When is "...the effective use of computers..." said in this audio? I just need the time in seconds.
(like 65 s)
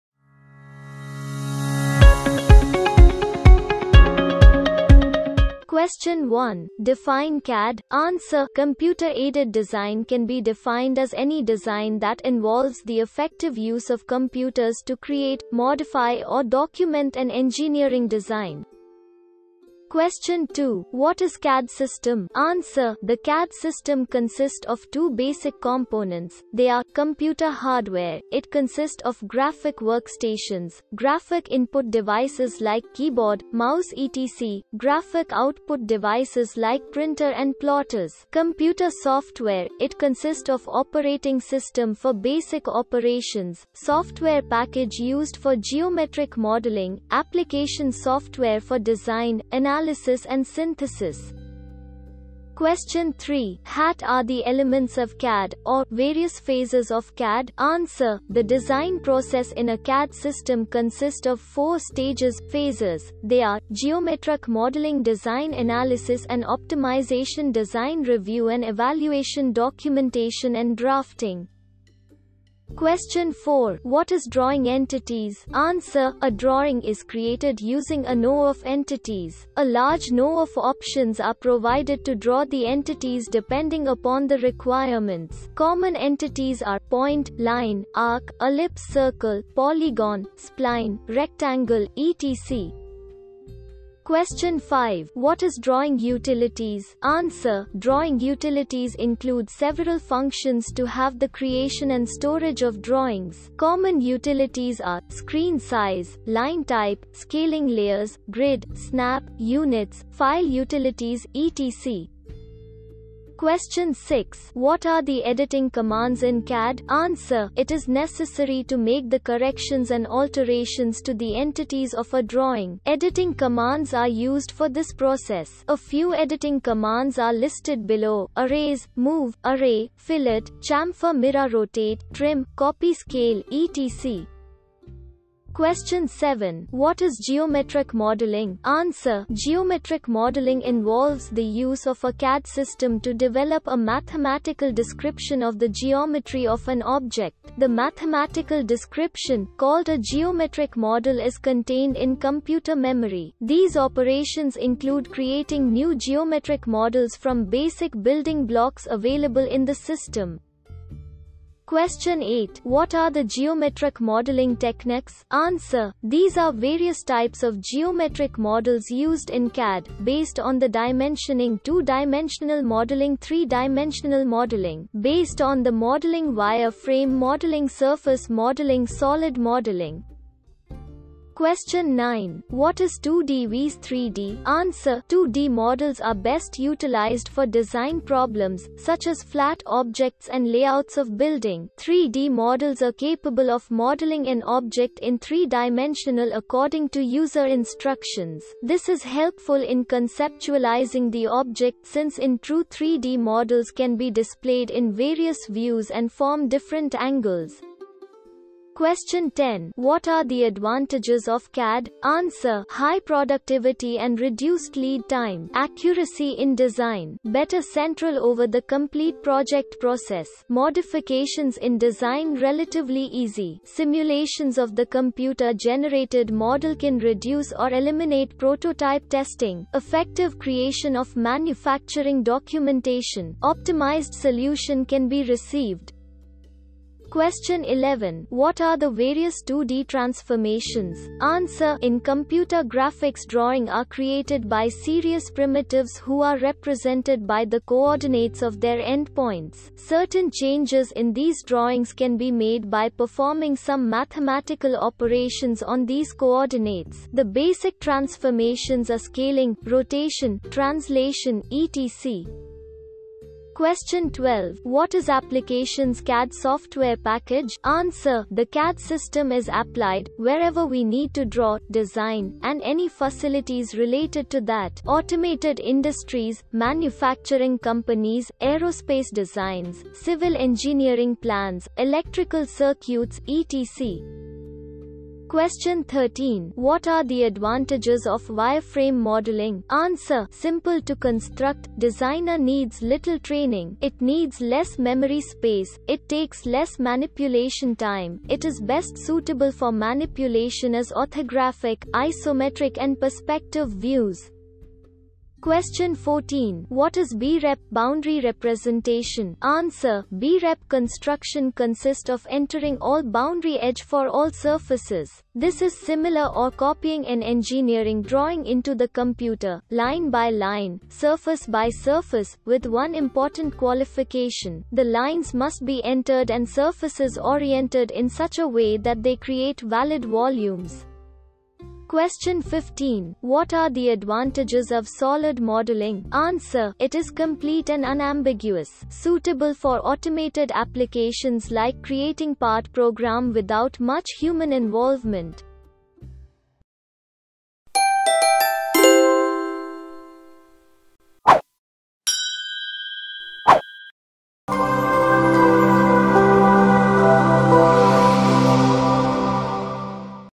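12 s.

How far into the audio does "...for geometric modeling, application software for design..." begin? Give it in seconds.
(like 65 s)
45 s.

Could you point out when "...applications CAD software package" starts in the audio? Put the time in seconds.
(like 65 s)
265 s.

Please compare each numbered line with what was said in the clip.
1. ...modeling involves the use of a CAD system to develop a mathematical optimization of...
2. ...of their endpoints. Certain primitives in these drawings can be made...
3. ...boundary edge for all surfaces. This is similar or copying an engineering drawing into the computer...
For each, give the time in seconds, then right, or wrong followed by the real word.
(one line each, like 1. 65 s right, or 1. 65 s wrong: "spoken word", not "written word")
1. 140 s wrong: "description", not "optimization"
2. 248 s wrong: "changes", not "primitives"
3. 313 s right.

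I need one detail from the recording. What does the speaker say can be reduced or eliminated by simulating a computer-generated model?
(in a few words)
prototype testing.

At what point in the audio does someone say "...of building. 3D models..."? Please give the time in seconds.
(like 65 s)
190 s.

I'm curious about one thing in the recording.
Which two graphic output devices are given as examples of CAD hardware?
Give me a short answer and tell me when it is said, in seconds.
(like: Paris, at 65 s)
printer and plotters, at 36 s.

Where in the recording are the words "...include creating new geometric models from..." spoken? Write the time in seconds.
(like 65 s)
154 s.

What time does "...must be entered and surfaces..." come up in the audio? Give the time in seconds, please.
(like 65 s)
325 s.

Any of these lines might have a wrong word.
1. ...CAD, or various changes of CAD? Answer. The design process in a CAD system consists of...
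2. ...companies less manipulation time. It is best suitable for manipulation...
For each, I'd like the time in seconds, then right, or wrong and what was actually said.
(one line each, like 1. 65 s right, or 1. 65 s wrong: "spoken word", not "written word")
1. 55 s wrong: "phases", not "changes"
2. 296 s wrong: "takes", not "companies".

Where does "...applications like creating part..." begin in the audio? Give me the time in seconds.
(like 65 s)
340 s.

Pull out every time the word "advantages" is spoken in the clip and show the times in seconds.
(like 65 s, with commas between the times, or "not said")
210 s, 287 s, 333 s.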